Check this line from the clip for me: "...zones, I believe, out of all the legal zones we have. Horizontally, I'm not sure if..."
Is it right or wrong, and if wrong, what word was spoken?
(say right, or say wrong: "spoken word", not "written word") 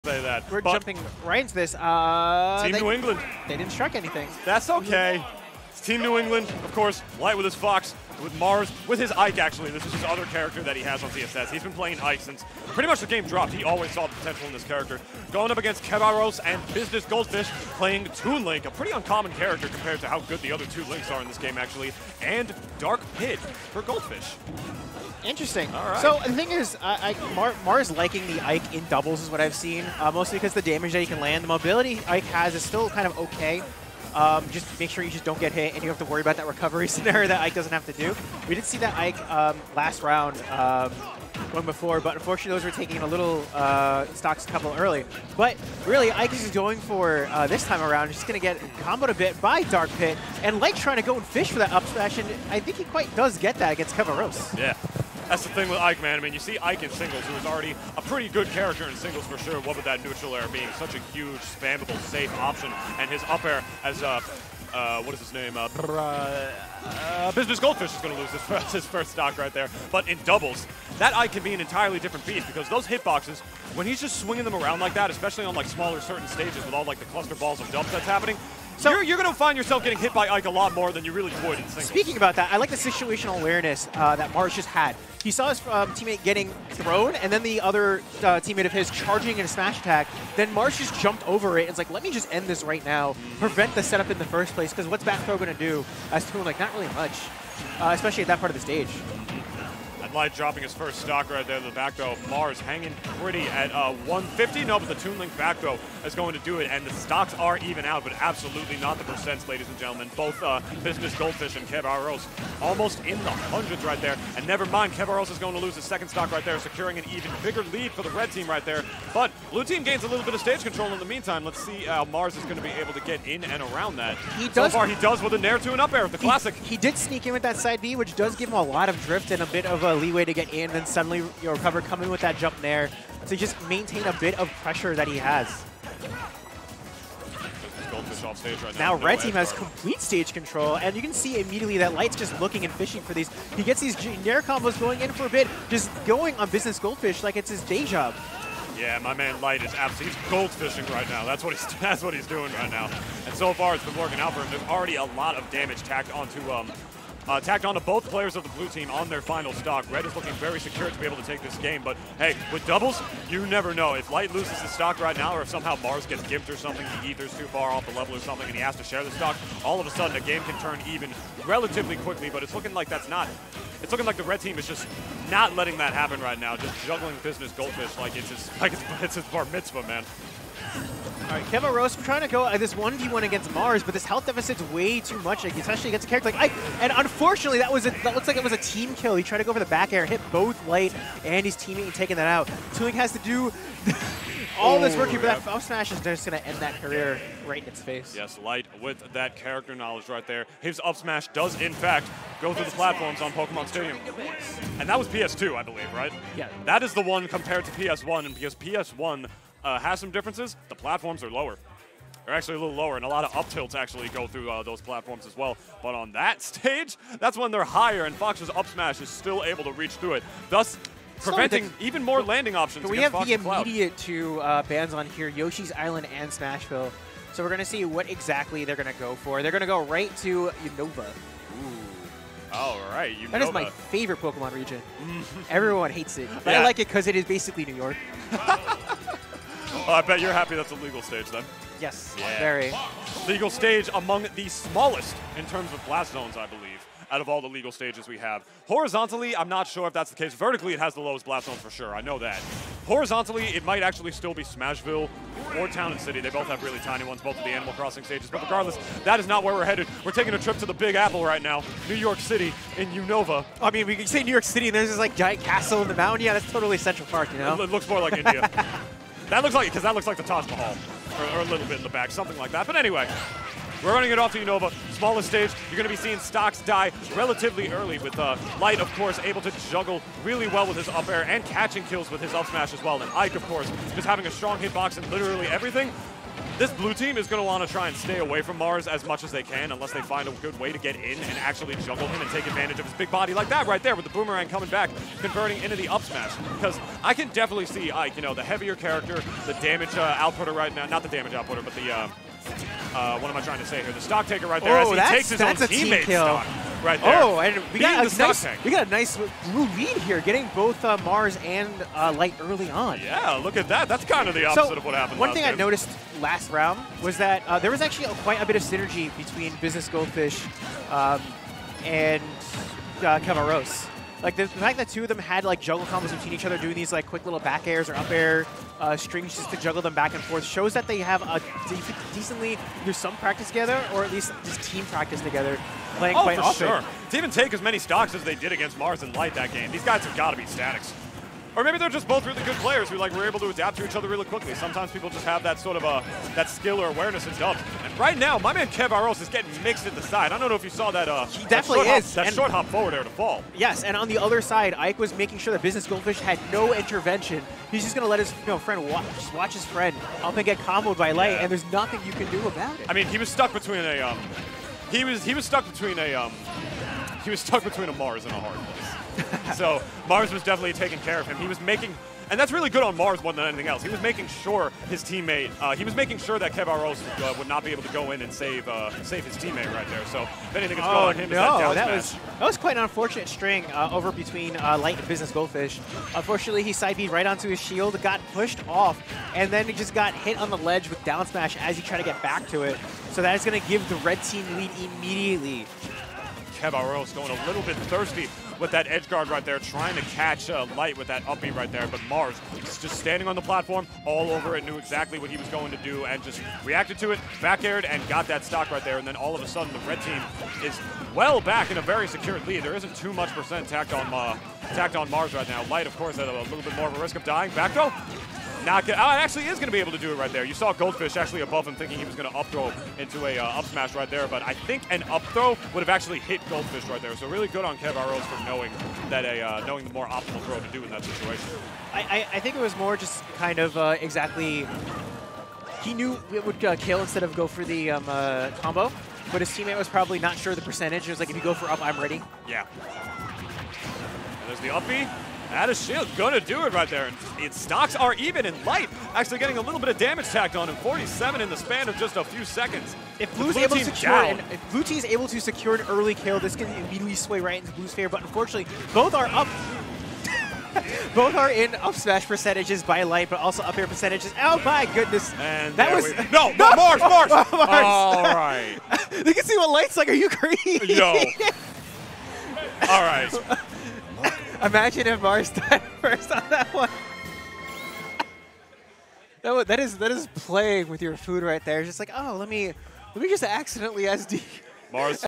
wrong: "stages", not "zones".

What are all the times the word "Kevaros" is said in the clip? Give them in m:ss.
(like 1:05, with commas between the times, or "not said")
0:15, 0:53, 6:16, 6:36.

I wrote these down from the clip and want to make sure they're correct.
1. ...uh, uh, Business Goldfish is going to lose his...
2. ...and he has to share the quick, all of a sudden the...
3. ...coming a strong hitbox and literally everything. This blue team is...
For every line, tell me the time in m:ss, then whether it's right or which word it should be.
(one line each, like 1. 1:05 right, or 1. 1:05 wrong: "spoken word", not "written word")
1. 1:05 right
2. 2:48 wrong: "stock", not "quick"
3. 4:44 wrong: "having", not "coming".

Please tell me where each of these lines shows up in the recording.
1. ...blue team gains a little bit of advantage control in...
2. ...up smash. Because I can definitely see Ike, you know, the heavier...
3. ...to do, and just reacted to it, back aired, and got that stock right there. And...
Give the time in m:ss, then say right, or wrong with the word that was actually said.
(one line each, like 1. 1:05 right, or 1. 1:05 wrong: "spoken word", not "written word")
1. 1:59 wrong: "stage", not "advantage"
2. 4:55 right
3. 6:45 right.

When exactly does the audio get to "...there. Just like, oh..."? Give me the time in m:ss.
8:01.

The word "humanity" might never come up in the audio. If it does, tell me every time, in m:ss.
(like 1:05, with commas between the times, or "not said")
not said.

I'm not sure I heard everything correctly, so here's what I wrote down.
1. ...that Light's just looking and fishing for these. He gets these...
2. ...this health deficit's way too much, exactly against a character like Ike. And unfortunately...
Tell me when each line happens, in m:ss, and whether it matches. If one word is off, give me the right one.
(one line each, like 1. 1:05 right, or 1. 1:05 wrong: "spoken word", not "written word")
1. 2:21 right
2. 3:03 wrong: "especially", not "exactly".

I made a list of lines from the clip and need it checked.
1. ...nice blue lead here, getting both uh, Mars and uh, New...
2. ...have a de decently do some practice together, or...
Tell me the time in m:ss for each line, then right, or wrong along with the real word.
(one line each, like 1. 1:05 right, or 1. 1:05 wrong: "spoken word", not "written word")
1. 5:08 wrong: "Light", not "New"
2. 5:30 right.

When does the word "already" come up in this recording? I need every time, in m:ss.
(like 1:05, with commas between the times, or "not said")
0:57, 2:34.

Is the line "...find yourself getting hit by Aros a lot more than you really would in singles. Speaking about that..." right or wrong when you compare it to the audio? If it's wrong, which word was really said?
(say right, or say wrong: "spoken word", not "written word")
wrong: "Ike", not "Aros".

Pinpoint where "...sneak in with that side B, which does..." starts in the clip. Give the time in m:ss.
2:06.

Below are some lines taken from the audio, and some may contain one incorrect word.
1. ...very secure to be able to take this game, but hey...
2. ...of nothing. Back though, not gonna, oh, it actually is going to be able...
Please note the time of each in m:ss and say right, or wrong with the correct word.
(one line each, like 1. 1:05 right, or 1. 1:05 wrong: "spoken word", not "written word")
1. 2:40 right
2. 6:57 wrong: "dying", not "nothing".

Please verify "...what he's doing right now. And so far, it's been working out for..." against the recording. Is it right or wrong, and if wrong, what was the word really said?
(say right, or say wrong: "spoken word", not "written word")
right.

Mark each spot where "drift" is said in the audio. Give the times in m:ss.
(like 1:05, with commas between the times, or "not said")
2:09.